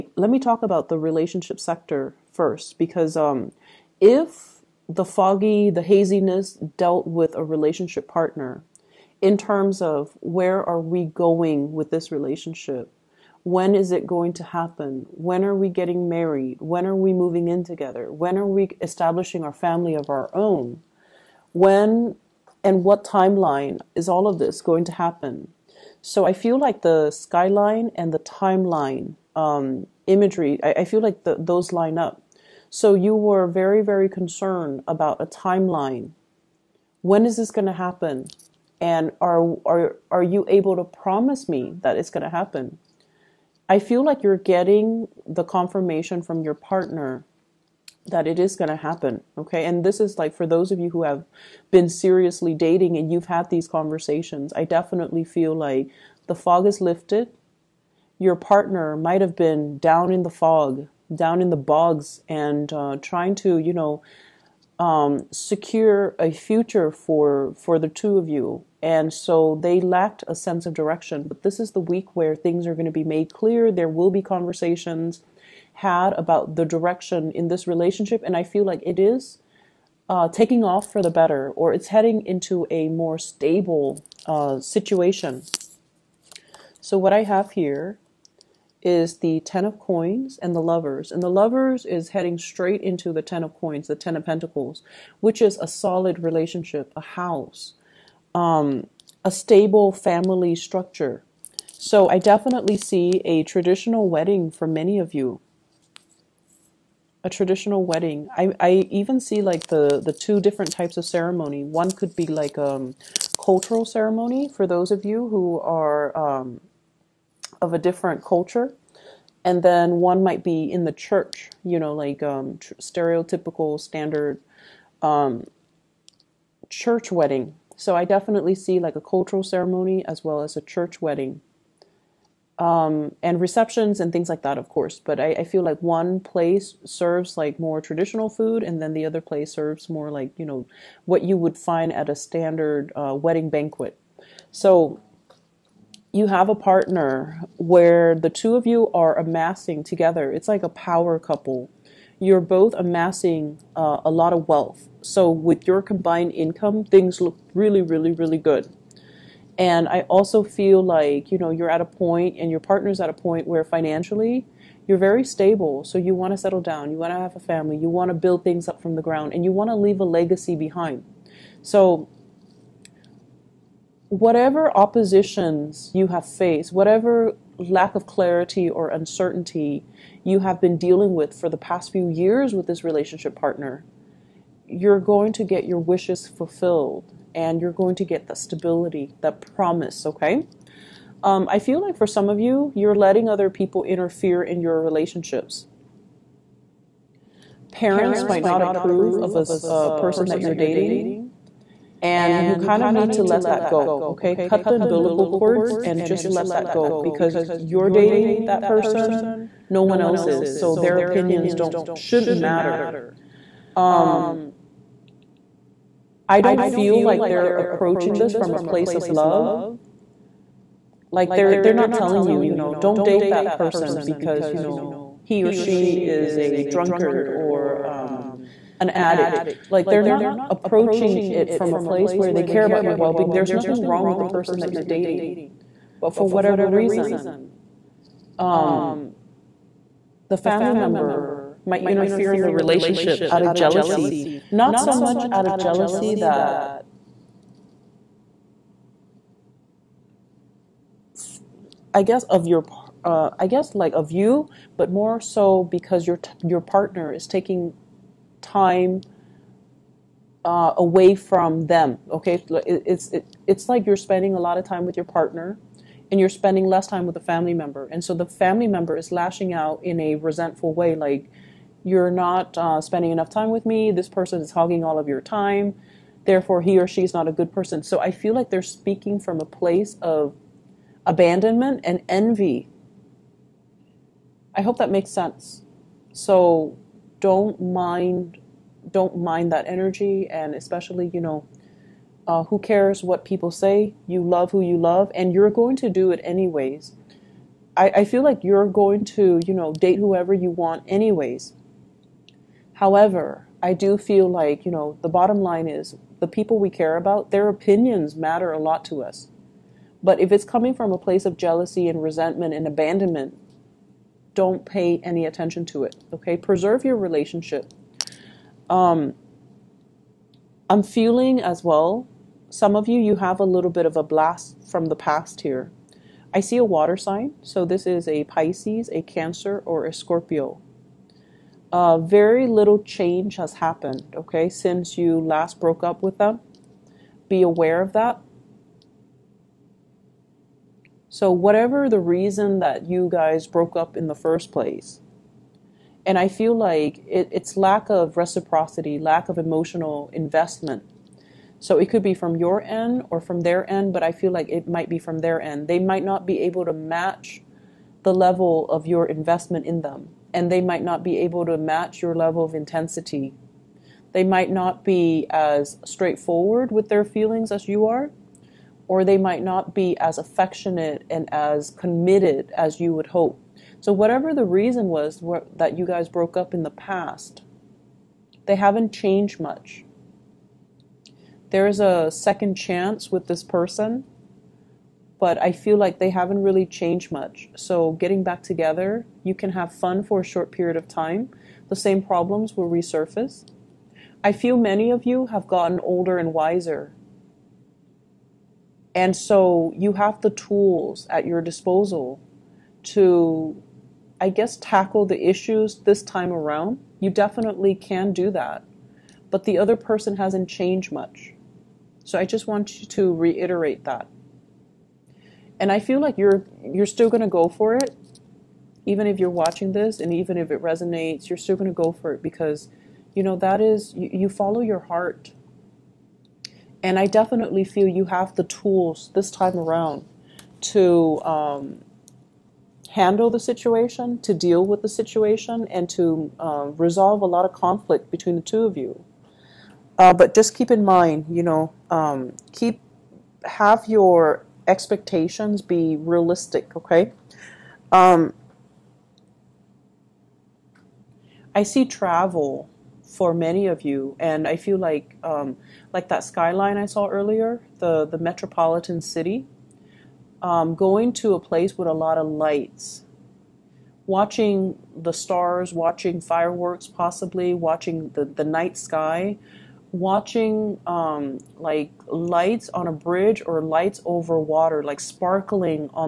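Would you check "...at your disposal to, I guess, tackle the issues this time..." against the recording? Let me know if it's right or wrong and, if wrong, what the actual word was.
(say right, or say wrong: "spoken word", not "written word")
right.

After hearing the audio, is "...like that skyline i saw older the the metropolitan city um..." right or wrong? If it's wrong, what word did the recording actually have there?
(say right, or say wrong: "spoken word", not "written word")
wrong: "earlier", not "older".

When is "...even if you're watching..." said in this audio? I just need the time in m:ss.
6:58.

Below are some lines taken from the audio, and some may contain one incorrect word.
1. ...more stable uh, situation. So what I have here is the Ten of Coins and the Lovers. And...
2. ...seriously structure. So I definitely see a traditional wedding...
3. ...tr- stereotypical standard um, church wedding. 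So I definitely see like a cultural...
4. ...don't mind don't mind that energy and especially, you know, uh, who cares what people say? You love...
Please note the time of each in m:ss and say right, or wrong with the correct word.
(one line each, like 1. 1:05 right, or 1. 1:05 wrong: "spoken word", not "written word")
1. 1:22 right
2. 1:39 wrong: "family", not "seriously"
3. 2:02 right
4. 4:47 right.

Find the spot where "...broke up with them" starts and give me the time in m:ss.
5:35.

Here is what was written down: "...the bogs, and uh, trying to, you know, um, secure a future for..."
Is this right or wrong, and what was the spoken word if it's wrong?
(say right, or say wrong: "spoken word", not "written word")
right.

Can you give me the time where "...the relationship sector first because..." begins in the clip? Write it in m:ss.
0:00.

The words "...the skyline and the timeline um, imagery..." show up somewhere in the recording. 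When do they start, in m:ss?
0:26.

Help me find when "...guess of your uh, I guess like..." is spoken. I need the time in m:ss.
4:12.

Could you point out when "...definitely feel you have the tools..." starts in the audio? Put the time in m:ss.
7:07.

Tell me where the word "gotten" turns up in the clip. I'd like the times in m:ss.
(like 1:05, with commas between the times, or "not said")
6:35.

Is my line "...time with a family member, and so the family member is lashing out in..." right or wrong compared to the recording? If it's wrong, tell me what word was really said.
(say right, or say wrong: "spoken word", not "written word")
right.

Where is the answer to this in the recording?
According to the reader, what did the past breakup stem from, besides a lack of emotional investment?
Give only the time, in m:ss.
5:47.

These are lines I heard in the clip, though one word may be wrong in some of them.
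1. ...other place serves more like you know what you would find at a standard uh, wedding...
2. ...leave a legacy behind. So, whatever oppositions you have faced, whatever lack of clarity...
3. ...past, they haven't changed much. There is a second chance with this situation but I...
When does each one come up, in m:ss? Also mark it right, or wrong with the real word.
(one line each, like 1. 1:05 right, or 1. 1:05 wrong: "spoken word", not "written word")
1. 2:19 right
2. 2:49 right
3. 6:16 wrong: "person", not "situation".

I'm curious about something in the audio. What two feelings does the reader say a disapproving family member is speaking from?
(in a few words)
Abandonment and envy.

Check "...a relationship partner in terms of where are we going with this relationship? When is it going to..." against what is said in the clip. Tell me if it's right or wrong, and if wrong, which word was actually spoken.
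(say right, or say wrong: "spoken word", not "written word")
right.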